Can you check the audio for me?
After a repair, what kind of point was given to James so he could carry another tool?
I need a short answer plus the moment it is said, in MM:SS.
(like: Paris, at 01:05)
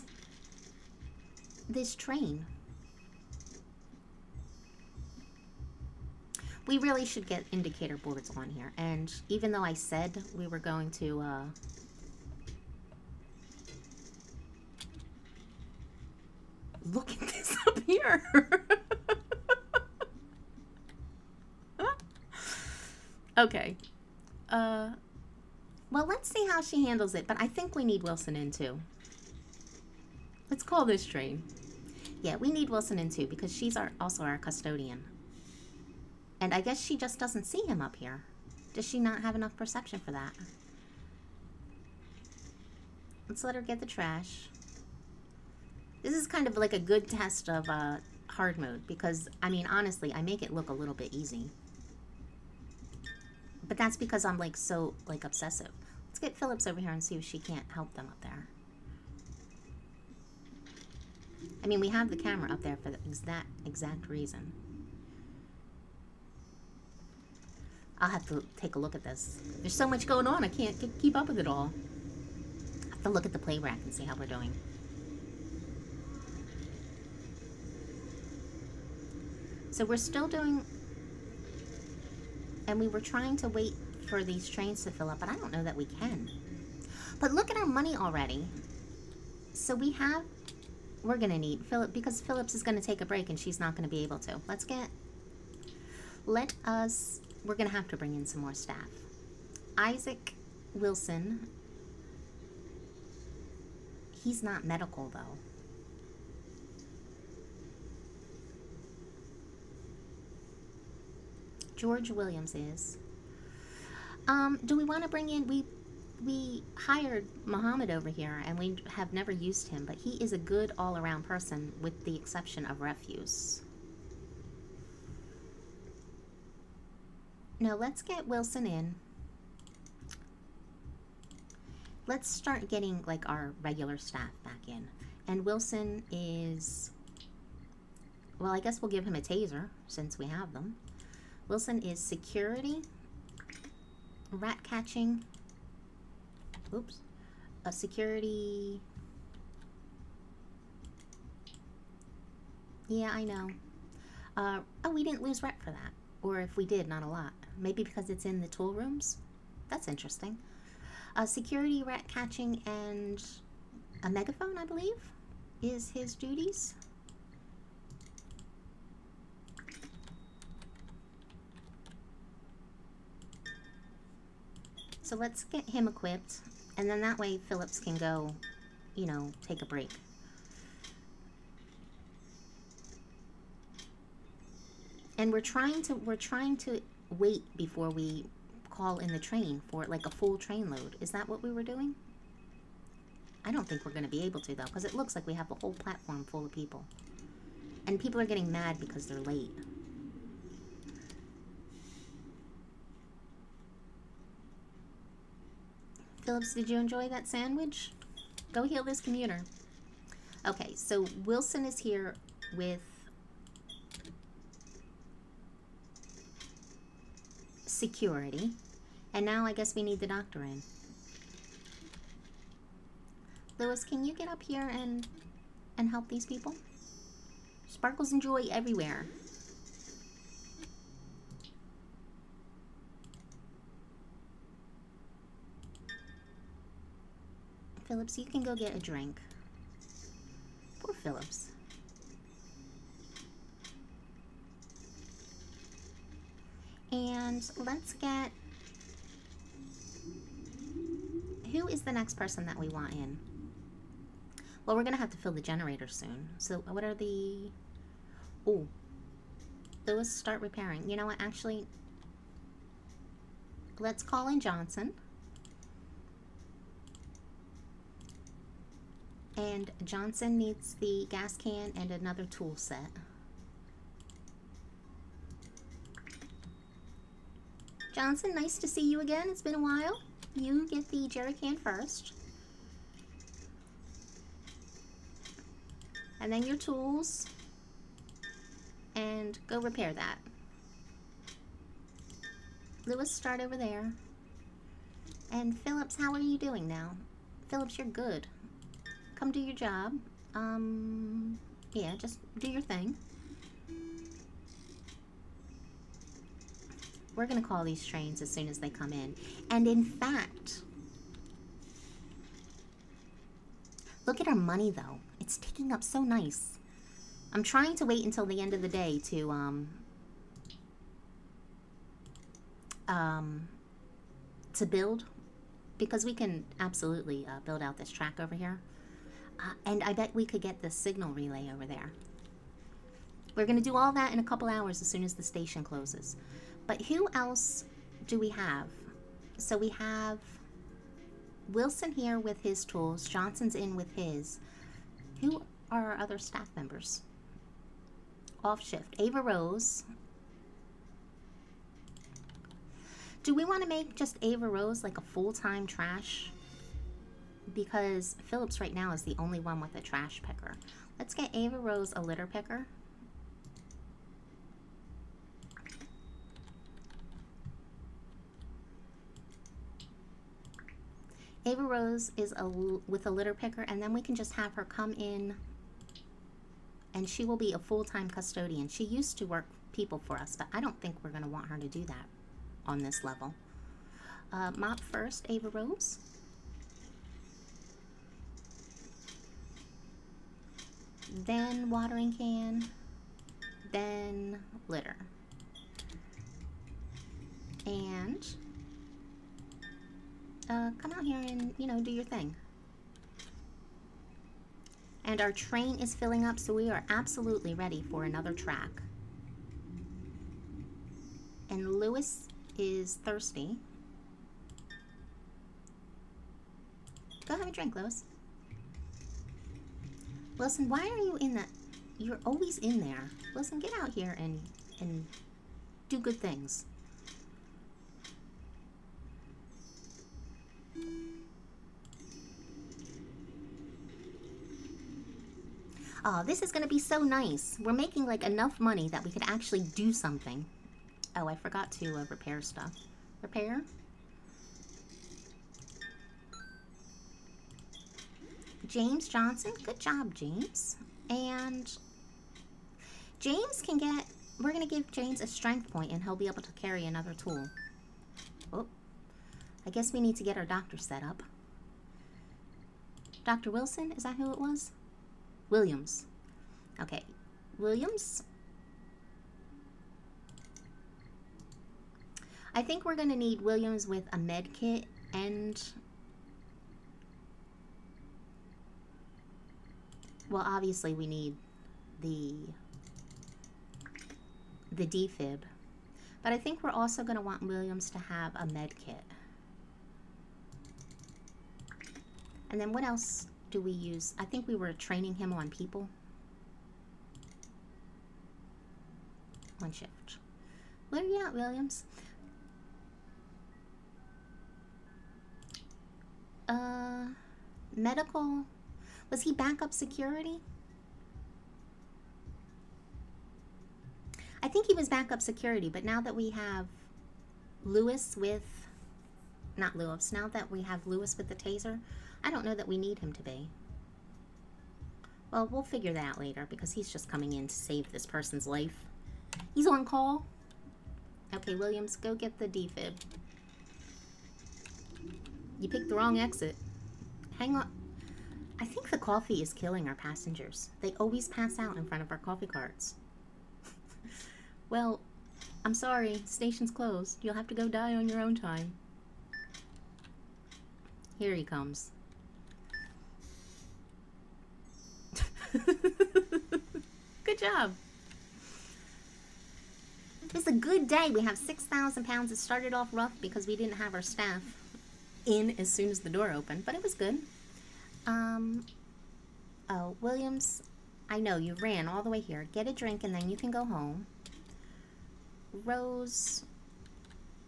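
strength point, at 07:35.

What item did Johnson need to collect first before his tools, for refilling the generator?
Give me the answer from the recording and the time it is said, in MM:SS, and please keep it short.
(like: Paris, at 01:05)
jerry can, at 04:41.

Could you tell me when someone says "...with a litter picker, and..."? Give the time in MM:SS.
06:12.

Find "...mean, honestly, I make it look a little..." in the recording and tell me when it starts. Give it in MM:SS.
00:49.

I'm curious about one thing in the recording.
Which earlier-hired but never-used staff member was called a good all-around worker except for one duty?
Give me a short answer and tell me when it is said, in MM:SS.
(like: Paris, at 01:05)
Muhammad, at 01:57.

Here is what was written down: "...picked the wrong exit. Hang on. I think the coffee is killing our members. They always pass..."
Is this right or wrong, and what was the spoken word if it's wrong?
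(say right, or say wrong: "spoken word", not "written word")
wrong: "passengers", not "members".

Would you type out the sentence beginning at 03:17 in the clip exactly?
And people are getting mad because they're late.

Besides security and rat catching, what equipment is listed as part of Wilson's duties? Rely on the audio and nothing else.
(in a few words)
megaphone.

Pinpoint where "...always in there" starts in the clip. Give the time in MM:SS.
07:02.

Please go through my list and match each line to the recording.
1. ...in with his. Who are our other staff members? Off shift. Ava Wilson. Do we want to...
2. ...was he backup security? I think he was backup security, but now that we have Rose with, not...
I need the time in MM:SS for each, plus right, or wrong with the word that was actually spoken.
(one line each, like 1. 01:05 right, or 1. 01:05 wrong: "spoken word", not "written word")
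1. 05:43 wrong: "Rose", not "Wilson"
2. 08:29 wrong: "Lewis", not "Rose".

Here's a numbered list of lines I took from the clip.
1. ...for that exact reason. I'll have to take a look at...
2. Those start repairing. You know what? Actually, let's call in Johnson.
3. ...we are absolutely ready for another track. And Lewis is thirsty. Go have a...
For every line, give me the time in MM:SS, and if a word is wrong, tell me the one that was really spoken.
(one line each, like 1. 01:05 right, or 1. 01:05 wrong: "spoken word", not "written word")
1. 01:02 right
2. 04:19 right
3. 06:46 right.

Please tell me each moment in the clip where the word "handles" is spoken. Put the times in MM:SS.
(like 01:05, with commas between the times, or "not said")
00:26.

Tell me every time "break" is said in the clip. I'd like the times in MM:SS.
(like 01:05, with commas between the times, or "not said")
01:33, 02:59.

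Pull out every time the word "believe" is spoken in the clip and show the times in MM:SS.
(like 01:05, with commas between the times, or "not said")
02:44.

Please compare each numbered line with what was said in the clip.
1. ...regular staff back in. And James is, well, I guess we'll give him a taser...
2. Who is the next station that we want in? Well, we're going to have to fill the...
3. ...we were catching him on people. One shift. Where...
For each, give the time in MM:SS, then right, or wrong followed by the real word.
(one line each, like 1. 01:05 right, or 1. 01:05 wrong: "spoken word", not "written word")
1. 02:13 wrong: "Wilson", not "James"
2. 04:11 wrong: "person", not "station"
3. 08:14 wrong: "training", not "catching".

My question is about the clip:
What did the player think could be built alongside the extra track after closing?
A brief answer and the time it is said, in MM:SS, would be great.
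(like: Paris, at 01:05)
signal relay, at 05:30.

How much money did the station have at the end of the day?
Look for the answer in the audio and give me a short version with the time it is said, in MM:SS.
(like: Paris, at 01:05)
6,000 pounds, at 09:21.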